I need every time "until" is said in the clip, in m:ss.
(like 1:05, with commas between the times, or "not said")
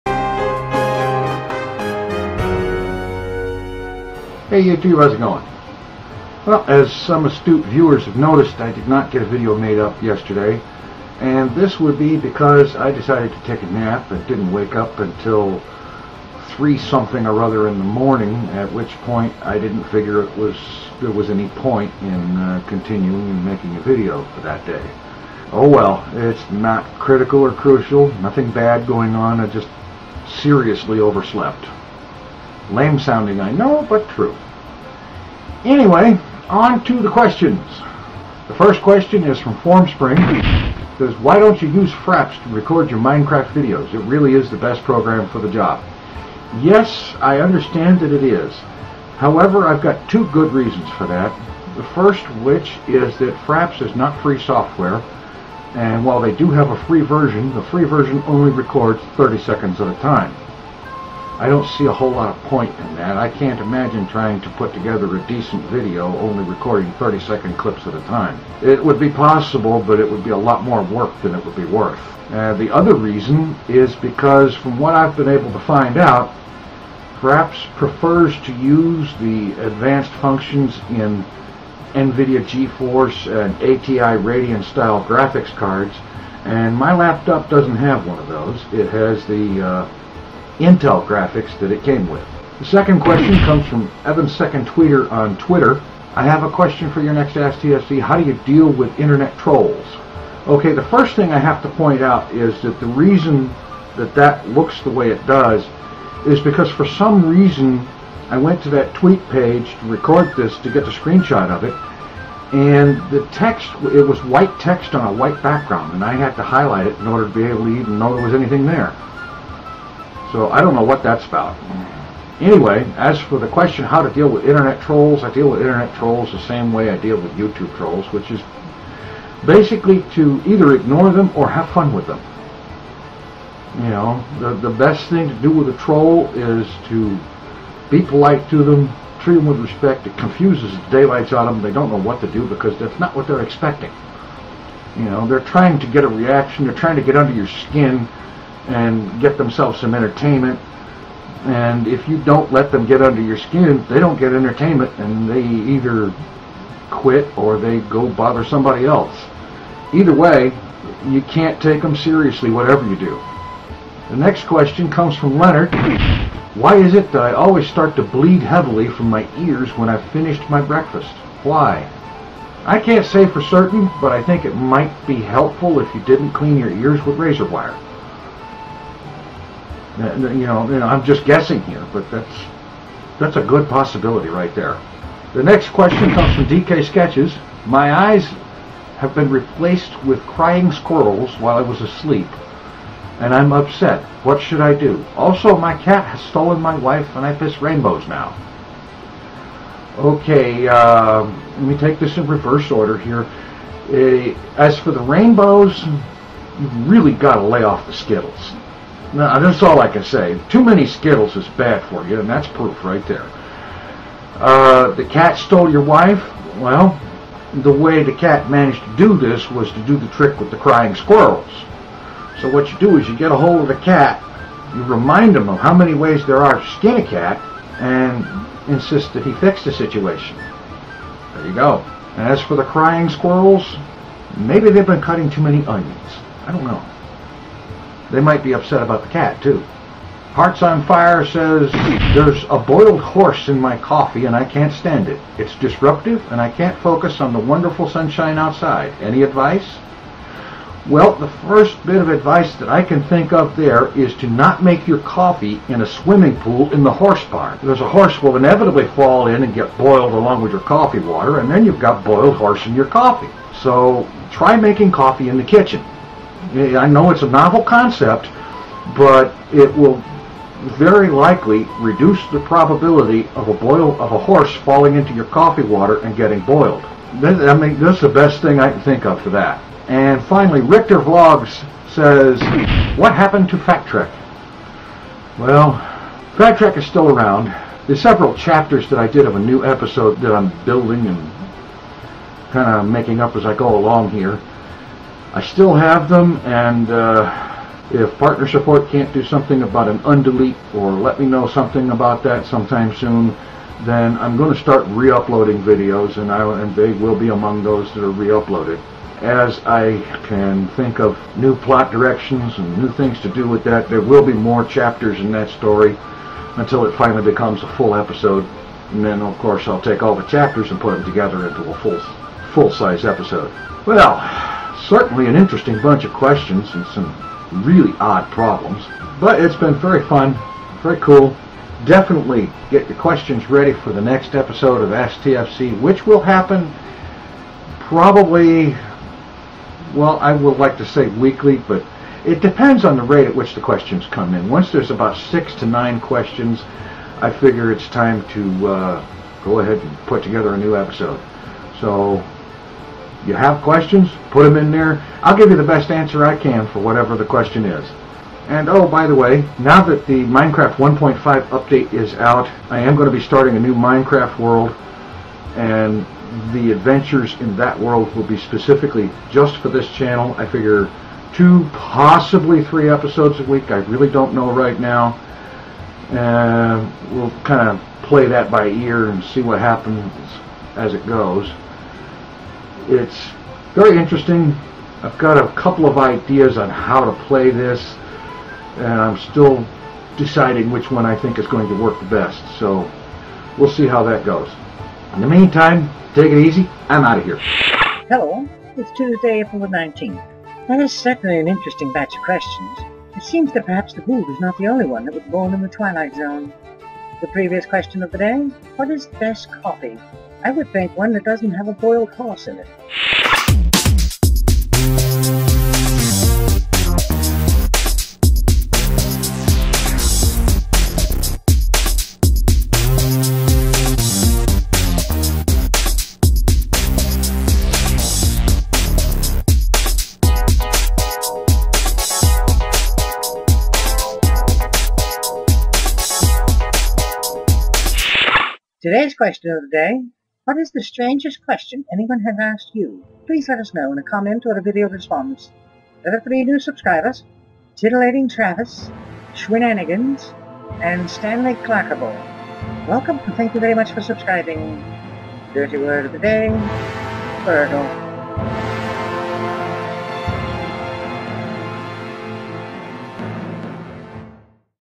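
0:14, 5:16.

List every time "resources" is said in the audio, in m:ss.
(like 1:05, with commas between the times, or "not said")
not said.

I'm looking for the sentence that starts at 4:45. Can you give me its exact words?
Well, Phat Trek is still around.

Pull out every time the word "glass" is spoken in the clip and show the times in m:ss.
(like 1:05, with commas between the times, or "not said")
not said.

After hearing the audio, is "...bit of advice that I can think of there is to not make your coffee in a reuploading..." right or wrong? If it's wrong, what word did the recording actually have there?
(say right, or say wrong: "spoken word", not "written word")
wrong: "swimming", not "reuploading".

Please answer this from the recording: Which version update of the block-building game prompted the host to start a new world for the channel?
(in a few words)
1.5.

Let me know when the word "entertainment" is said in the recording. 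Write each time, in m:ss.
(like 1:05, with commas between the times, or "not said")
2:29, 2:34.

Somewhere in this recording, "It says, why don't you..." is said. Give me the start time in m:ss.
0:40.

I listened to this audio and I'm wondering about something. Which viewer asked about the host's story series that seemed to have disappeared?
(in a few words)
Richter Vlogs.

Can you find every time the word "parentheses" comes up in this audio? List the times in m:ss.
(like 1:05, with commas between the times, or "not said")
not said.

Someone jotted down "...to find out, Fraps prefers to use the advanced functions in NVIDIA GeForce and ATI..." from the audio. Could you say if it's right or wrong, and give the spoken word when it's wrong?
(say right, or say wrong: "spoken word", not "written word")
right.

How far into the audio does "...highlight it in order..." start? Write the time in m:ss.
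1:56.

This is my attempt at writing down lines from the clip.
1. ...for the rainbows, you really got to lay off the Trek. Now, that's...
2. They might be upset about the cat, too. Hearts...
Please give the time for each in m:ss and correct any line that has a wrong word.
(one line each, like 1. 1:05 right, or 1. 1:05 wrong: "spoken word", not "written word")
1. 3:24 wrong: "Skittles", not "Trek"
2. 3:58 right.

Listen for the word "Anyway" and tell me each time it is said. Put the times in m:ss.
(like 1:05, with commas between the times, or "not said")
0:35, 2:02.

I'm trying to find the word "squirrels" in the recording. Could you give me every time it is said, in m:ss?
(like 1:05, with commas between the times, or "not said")
3:10, 3:40, 3:53.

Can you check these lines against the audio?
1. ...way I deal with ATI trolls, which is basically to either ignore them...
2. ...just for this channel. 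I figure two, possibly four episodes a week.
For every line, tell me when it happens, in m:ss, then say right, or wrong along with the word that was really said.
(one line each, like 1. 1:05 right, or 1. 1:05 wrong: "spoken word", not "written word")
1. 2:06 wrong: "YouTube", not "ATI"
2. 6:09 wrong: "three", not "four".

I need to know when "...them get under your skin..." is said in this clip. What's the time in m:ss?
2:32.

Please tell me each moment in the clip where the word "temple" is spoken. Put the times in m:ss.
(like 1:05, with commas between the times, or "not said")
not said.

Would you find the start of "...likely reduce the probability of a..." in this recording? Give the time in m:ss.
4:31.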